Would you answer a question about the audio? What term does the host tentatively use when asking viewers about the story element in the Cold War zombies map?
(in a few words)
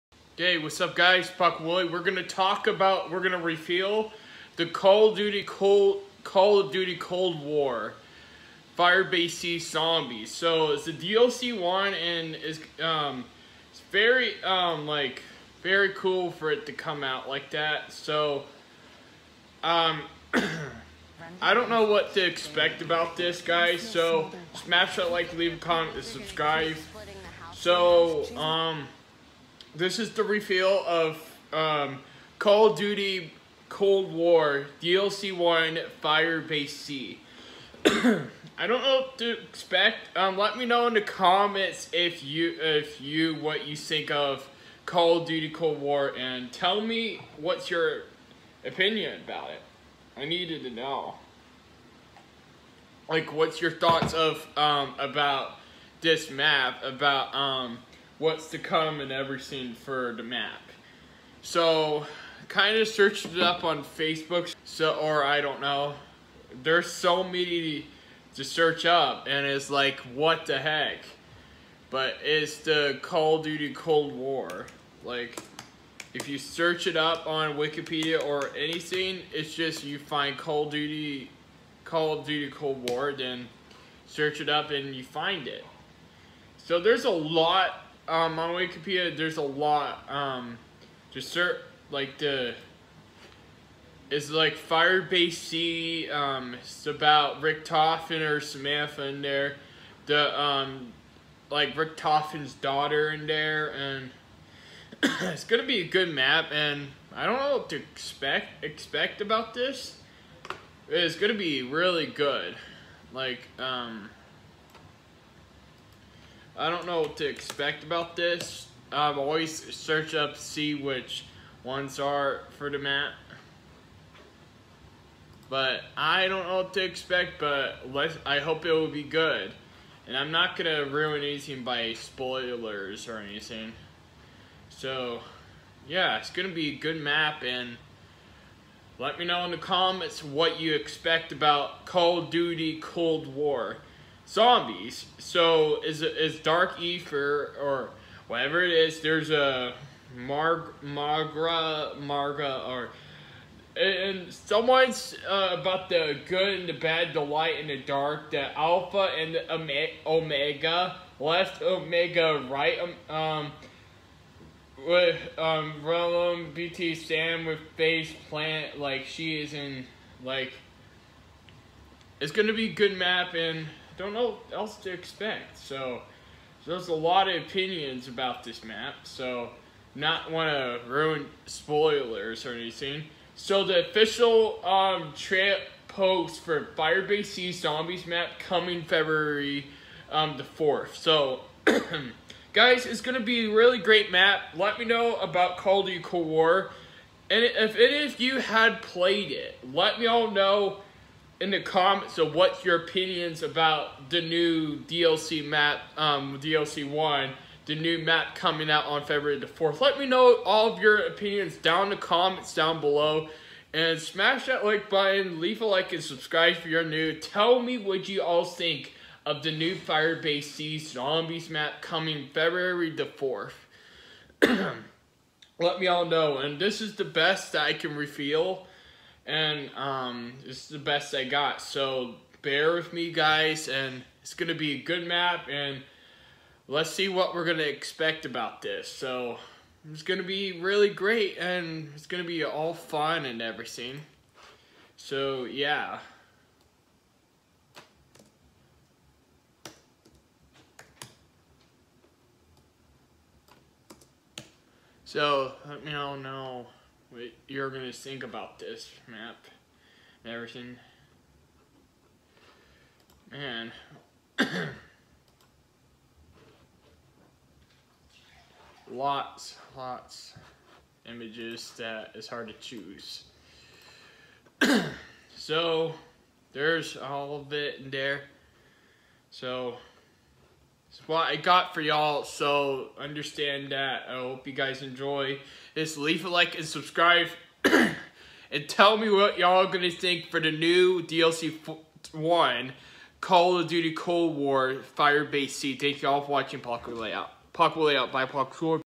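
Dark Ether.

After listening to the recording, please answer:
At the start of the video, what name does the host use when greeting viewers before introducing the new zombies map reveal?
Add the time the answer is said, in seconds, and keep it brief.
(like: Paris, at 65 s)
Buck Willie, at 1 s.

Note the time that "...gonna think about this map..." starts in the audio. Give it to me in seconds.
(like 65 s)
257 s.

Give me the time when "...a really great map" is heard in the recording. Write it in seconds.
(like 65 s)
193 s.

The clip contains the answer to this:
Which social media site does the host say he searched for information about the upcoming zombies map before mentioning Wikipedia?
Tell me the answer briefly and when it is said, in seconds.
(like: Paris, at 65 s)
Facebook, at 63 s.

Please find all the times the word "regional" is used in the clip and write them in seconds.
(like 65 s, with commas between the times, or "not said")
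not said.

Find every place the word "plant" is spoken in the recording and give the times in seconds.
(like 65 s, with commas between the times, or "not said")
168 s.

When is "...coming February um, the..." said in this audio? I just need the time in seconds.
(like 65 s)
188 s.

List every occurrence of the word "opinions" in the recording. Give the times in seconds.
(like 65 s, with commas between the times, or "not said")
48 s, 177 s, 202 s, 210 s.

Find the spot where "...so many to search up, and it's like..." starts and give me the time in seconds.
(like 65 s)
66 s.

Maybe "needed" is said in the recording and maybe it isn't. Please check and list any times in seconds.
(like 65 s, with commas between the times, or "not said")
50 s.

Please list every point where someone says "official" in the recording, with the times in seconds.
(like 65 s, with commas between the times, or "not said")
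183 s.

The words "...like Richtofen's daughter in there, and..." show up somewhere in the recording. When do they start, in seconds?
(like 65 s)
101 s.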